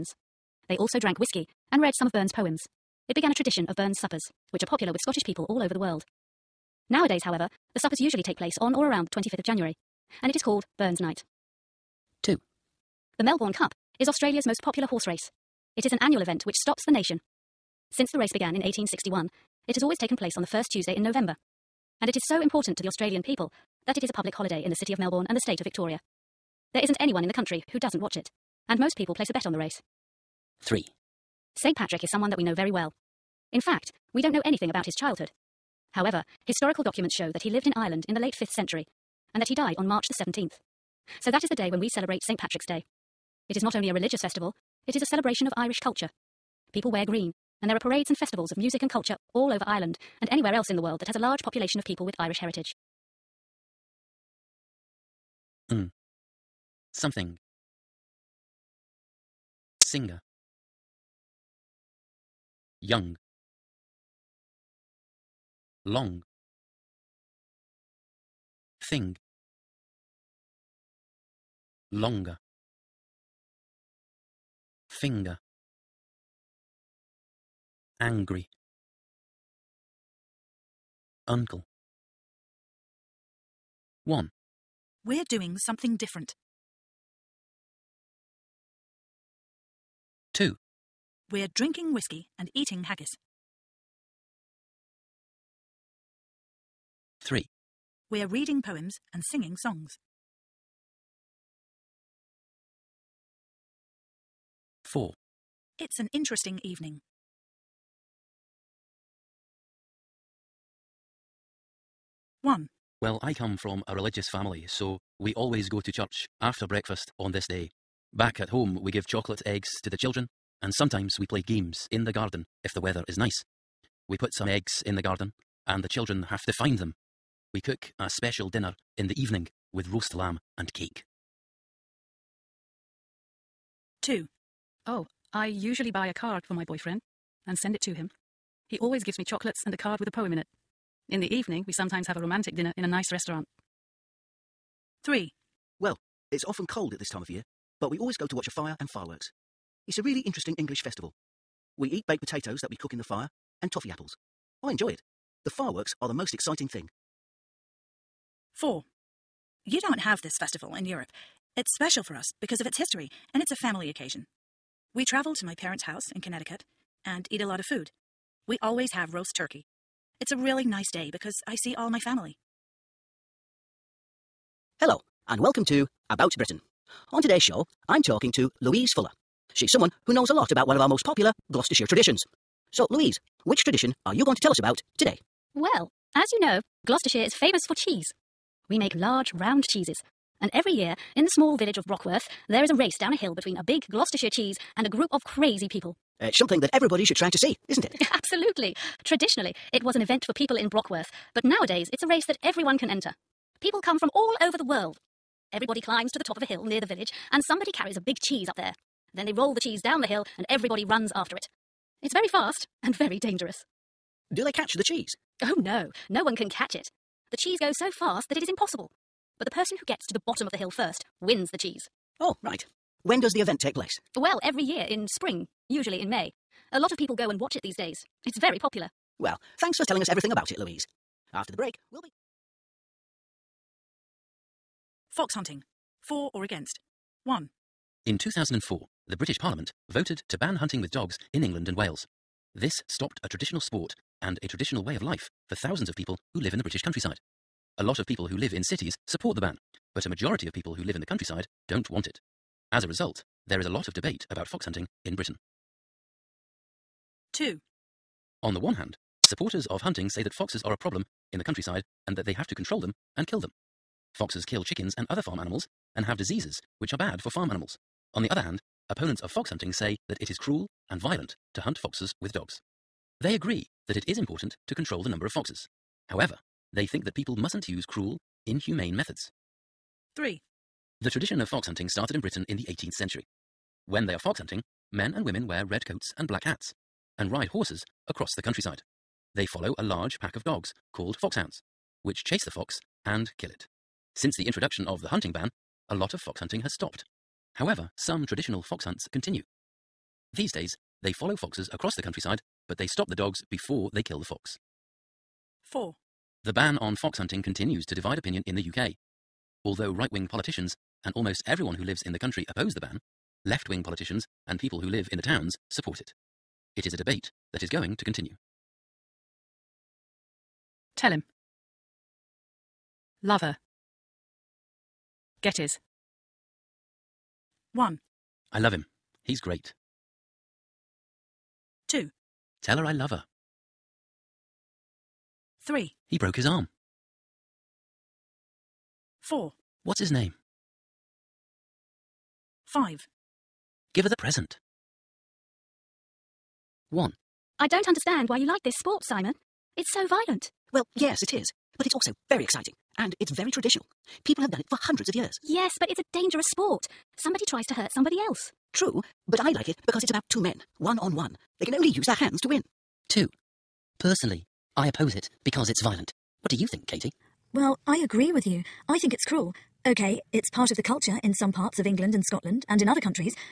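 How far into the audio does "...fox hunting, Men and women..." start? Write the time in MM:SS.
04:44.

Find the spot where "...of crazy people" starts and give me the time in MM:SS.
03:15.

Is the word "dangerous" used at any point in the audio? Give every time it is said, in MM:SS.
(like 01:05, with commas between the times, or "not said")
03:33, 05:56.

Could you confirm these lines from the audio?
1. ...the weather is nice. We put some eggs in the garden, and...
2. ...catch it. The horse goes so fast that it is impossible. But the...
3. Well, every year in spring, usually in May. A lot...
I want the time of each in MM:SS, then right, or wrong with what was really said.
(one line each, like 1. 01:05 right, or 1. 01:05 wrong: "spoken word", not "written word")
1. 02:02 right
2. 03:36 wrong: "cheese", not "horse"
3. 03:44 right.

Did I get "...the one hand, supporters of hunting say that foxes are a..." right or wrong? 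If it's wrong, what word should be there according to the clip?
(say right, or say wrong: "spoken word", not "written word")
right.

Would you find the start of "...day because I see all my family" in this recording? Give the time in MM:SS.
02:50.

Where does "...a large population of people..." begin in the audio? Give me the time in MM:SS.
00:51.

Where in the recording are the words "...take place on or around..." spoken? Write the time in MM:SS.
00:08.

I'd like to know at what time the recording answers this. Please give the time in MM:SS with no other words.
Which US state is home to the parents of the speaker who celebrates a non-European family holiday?
02:46.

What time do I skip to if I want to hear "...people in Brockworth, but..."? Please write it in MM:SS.
03:20.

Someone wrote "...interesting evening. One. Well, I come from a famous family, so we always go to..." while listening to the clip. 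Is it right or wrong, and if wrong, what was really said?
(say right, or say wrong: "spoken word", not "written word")
wrong: "religious", not "famous".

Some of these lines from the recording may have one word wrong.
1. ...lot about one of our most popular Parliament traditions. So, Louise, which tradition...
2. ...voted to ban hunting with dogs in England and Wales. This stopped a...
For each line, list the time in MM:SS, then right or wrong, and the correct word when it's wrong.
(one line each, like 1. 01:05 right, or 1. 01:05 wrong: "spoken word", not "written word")
1. 03:00 wrong: "Gloucestershire", not "Parliament"
2. 03:59 right.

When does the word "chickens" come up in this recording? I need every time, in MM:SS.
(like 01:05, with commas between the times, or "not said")
04:24.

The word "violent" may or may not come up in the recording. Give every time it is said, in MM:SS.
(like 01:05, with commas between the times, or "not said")
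04:30, 05:50, 06:05.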